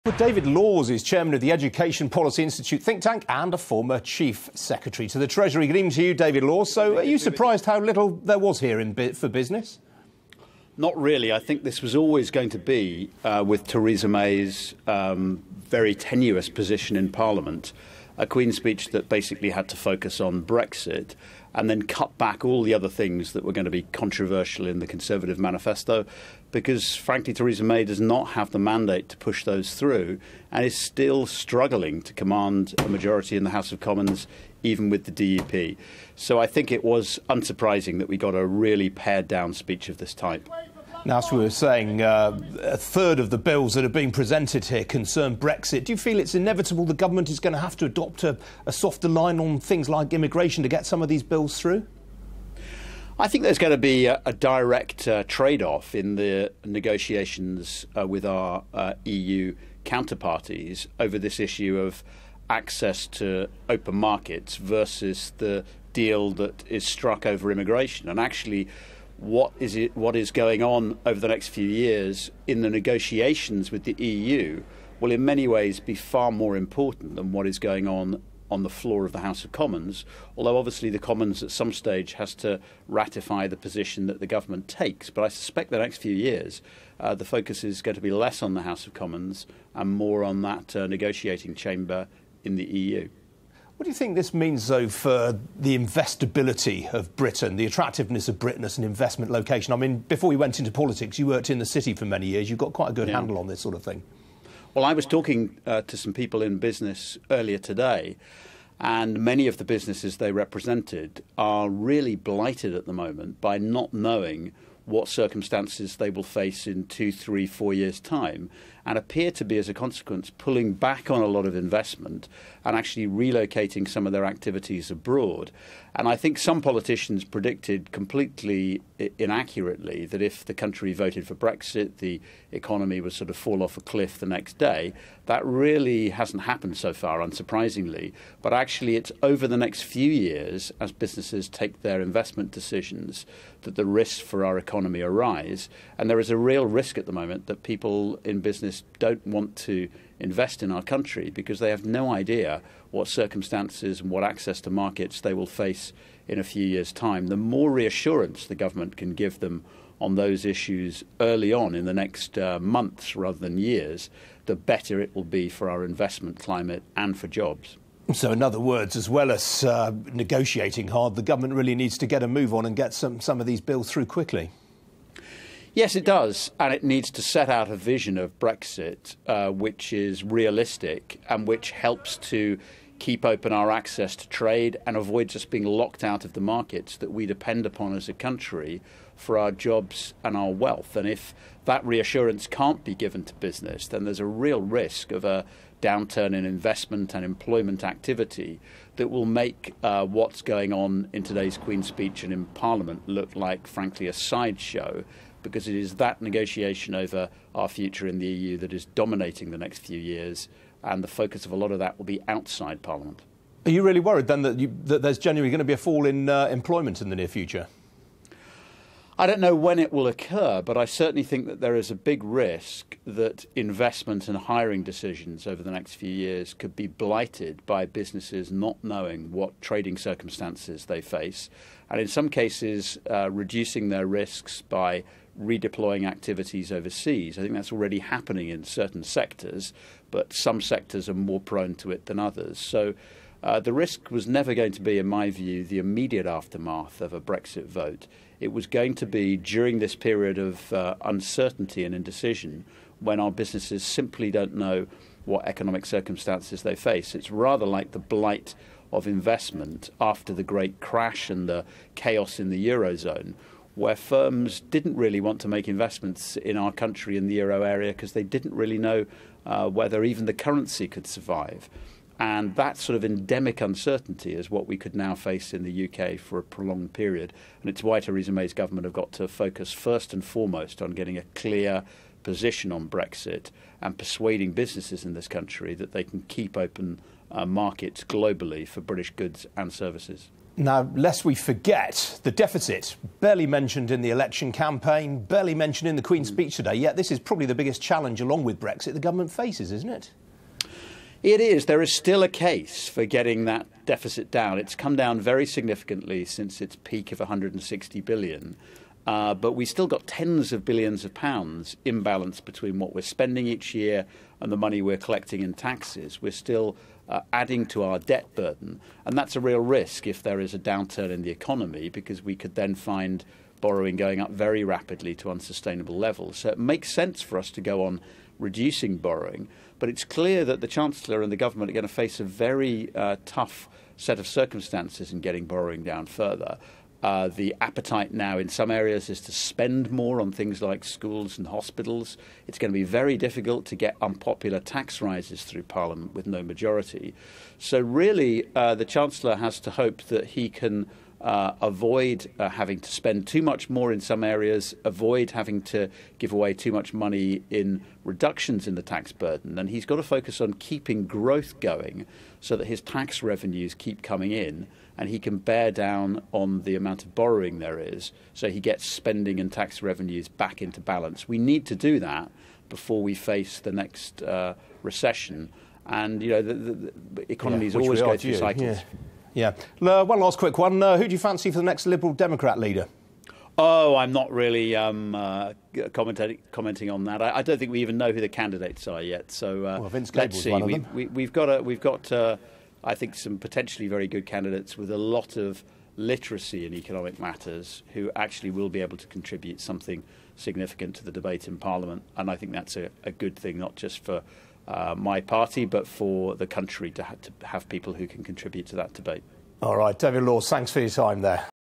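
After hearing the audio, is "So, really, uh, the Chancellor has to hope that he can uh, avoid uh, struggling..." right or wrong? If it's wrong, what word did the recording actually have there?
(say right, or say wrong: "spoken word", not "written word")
wrong: "having", not "struggling".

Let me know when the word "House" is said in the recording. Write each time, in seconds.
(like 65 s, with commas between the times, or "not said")
33 s, 79 s, 88 s.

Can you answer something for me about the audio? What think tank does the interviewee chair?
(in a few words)
Education Policy Institute.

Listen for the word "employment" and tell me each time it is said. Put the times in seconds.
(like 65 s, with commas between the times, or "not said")
197 s, 216 s.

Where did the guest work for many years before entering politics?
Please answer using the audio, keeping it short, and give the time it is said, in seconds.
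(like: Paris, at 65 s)
the city, at 101 s.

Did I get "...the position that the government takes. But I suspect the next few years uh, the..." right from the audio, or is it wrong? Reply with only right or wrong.
right.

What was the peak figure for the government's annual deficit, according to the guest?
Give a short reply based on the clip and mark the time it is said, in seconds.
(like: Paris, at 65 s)
160 billion, at 307 s.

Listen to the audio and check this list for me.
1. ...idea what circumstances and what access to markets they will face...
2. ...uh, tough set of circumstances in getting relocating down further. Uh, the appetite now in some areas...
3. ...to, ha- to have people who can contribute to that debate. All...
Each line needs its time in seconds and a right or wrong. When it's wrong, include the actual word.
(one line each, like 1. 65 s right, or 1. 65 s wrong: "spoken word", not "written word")
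1. 152 s right
2. 332 s wrong: "borrowing", not "relocating"
3. 406 s right.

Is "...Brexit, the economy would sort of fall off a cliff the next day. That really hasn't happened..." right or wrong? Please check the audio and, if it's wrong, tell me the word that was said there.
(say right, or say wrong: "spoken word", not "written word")
right.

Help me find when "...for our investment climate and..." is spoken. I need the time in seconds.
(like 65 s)
165 s.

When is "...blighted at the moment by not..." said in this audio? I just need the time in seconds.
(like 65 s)
112 s.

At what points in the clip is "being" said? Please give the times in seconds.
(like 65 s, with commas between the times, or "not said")
43 s, 185 s.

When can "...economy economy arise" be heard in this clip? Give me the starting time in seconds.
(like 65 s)
144 s.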